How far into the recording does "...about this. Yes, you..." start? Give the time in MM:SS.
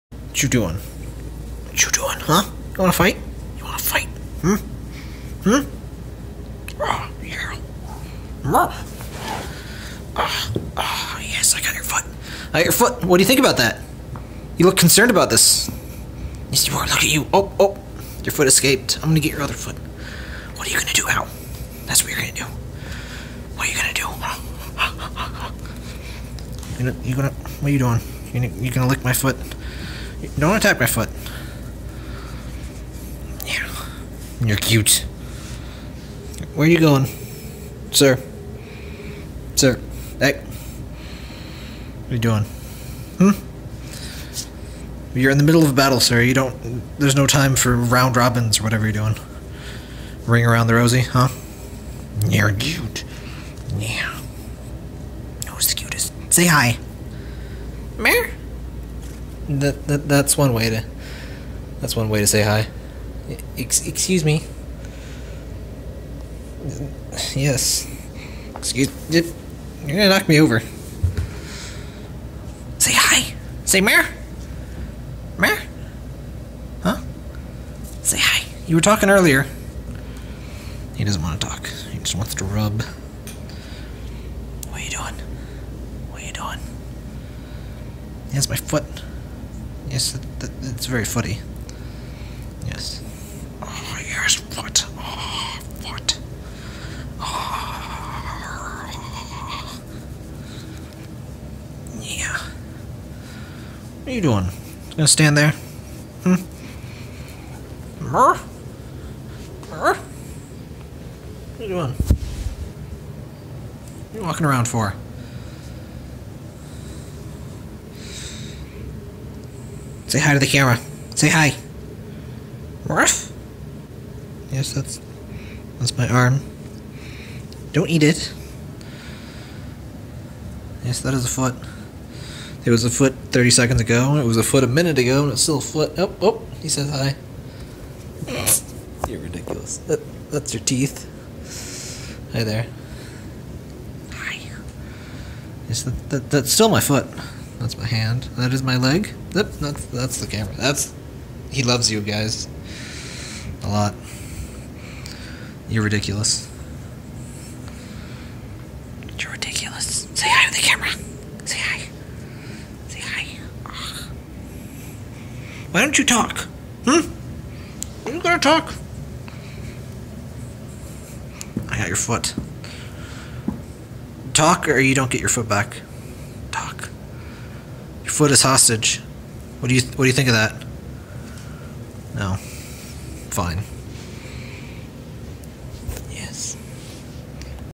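00:15.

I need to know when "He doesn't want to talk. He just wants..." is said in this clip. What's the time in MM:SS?
01:20.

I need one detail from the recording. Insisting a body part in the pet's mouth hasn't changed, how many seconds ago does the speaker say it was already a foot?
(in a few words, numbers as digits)
30.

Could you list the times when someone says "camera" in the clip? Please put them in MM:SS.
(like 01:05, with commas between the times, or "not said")
02:00, 02:30, 02:40.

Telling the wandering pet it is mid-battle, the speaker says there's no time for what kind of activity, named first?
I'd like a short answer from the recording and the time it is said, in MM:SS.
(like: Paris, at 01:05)
round robins, at 00:47.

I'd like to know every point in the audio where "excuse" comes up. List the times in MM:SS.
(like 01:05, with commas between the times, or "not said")
01:03, 01:08.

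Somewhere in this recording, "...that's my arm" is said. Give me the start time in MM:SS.
02:05.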